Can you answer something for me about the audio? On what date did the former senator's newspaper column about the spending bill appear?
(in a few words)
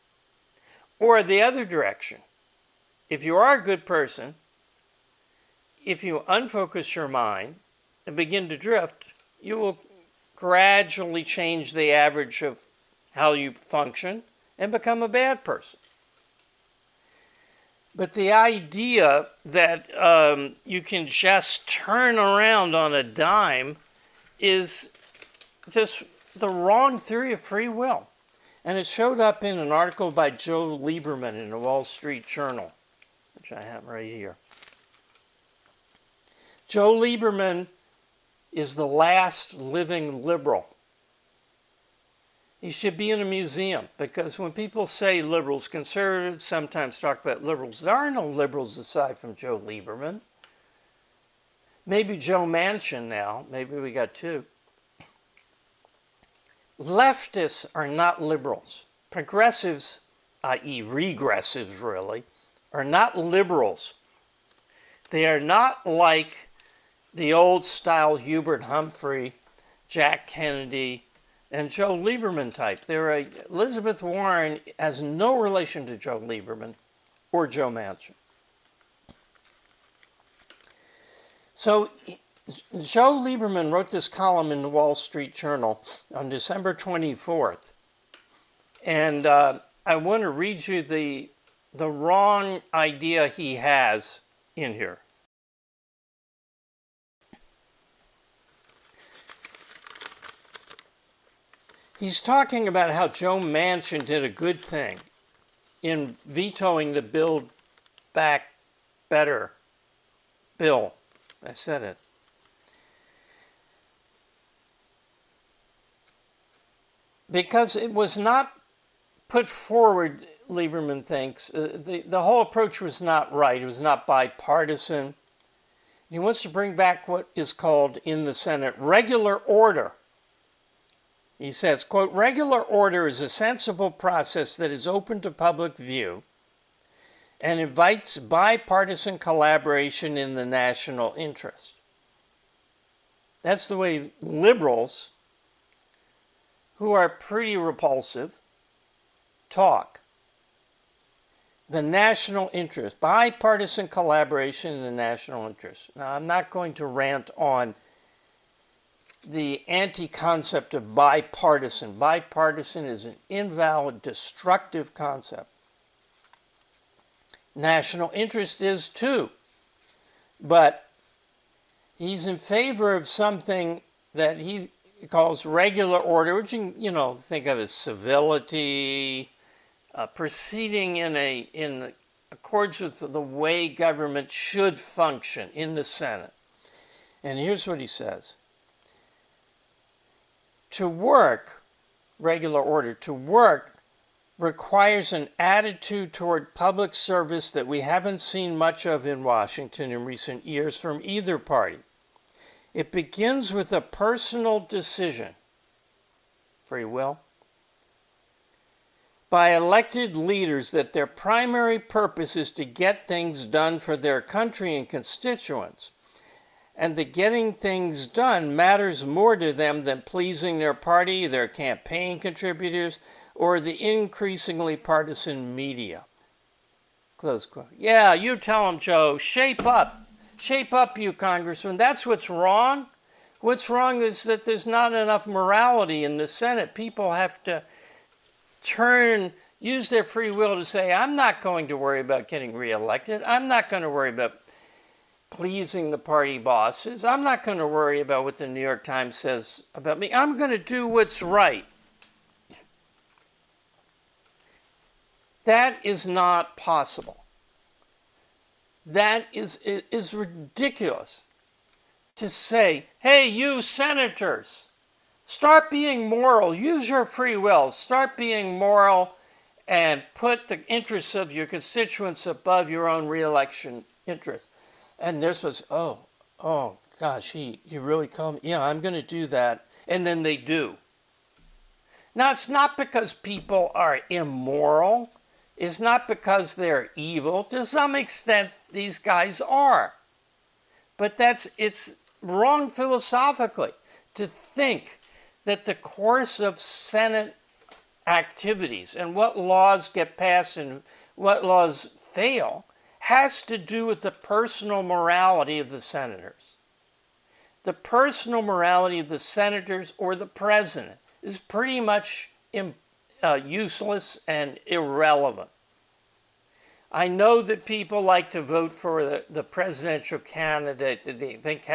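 December 24th.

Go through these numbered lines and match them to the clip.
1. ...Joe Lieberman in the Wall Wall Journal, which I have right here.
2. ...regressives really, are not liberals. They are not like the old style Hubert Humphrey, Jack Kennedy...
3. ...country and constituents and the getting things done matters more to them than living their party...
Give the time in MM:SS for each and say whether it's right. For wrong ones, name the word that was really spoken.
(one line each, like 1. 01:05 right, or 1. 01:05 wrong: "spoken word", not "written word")
1. 00:30 wrong: "Street", not "Wall"
2. 01:00 right
3. 03:34 wrong: "pleasing", not "living".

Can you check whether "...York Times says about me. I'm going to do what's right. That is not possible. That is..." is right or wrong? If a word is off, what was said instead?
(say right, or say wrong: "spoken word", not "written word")
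right.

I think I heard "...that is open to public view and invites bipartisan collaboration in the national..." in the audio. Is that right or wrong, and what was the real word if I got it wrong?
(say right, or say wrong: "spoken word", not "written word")
right.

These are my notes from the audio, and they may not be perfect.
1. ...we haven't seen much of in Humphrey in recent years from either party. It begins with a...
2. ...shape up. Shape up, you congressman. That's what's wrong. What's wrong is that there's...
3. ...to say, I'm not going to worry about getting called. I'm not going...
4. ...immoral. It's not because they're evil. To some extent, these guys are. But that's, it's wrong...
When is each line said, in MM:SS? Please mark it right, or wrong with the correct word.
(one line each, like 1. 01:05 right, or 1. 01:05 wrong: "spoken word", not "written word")
1. 03:17 wrong: "Washington", not "Humphrey"
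2. 03:49 right
3. 04:00 wrong: "reelected", not "called"
4. 04:44 right.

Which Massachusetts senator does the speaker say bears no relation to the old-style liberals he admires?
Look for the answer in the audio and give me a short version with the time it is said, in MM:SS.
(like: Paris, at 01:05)
Elizabeth Warren, at 01:13.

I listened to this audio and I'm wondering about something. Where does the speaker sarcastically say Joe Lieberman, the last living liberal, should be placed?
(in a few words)
a museum.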